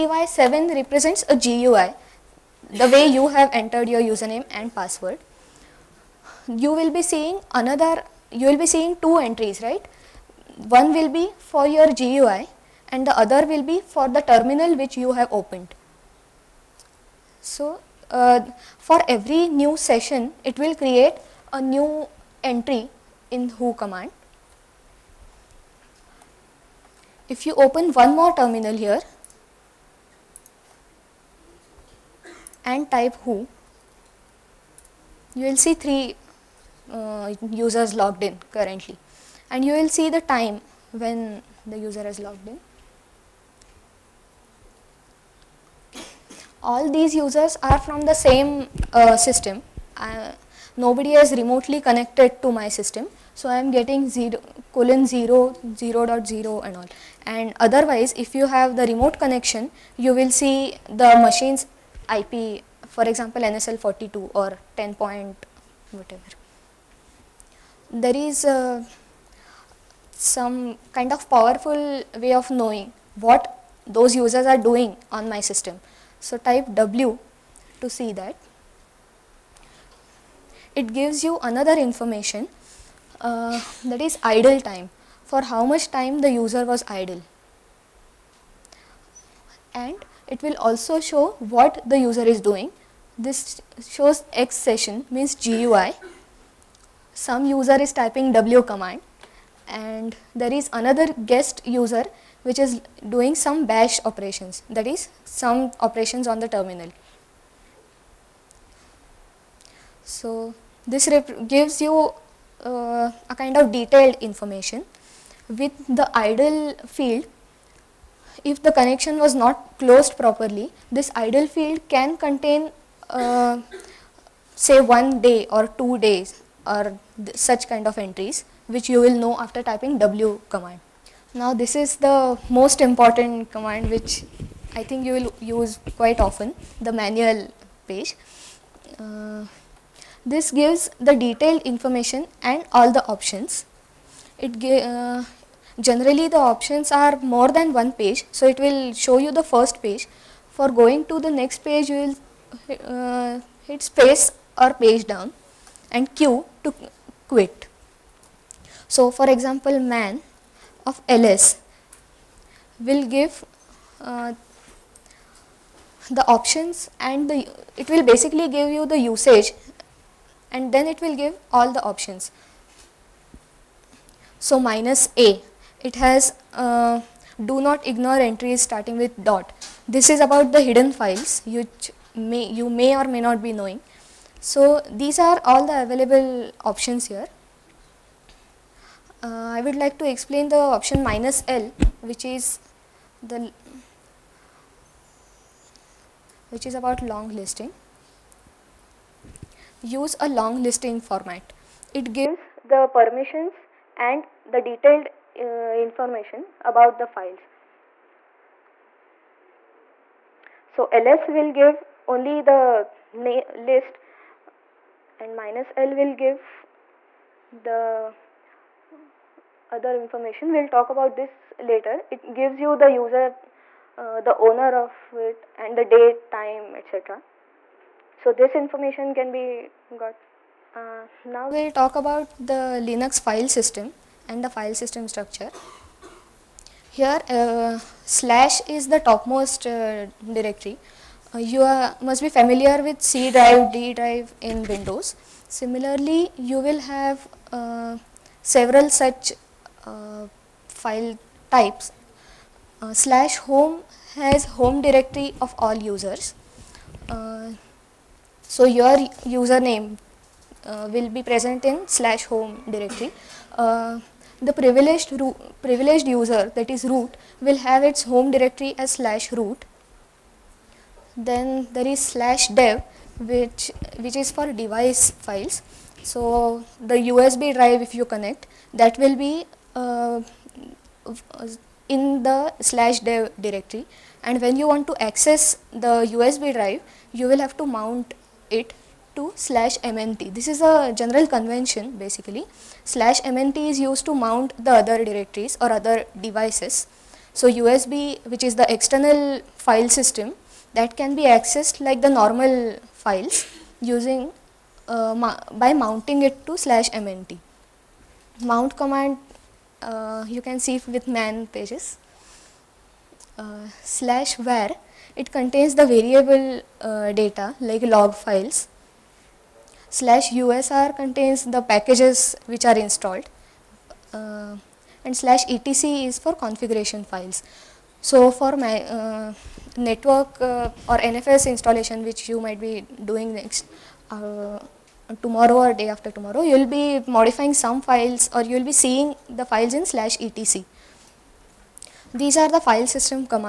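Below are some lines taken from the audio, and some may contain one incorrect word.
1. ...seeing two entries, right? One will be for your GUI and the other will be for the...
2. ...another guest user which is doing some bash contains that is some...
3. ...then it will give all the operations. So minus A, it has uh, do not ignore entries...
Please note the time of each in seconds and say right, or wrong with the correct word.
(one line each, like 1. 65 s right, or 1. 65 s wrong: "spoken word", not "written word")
1. 8 s right
2. 100 s wrong: "operations", not "contains"
3. 170 s wrong: "options", not "operations".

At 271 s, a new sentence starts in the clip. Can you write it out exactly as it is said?
Then there is slash dev which, which is for device files.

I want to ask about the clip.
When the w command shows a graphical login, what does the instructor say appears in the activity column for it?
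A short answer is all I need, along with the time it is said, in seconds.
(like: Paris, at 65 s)
X session, at 94 s.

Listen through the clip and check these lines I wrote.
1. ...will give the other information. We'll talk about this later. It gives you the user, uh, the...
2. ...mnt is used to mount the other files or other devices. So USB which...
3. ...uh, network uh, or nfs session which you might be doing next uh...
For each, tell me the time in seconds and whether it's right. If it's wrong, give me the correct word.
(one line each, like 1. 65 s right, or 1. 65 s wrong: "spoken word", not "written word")
1. 215 s right
2. 293 s wrong: "directories", not "files"
3. 328 s wrong: "installation", not "session".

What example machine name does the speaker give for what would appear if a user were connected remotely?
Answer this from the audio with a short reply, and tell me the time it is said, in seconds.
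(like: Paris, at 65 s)
NSL 42, at 63 s.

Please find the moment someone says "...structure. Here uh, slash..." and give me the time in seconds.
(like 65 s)
235 s.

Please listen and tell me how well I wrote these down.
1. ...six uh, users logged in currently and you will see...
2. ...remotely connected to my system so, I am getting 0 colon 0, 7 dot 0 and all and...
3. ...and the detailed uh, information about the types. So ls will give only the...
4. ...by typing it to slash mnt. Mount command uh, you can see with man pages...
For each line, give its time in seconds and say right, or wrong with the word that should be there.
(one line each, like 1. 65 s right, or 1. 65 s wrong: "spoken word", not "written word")
1. 35 s wrong: "three", not "six"
2. 51 s wrong: "0", not "7"
3. 203 s wrong: "files", not "types"
4. 305 s wrong: "mounting", not "typing".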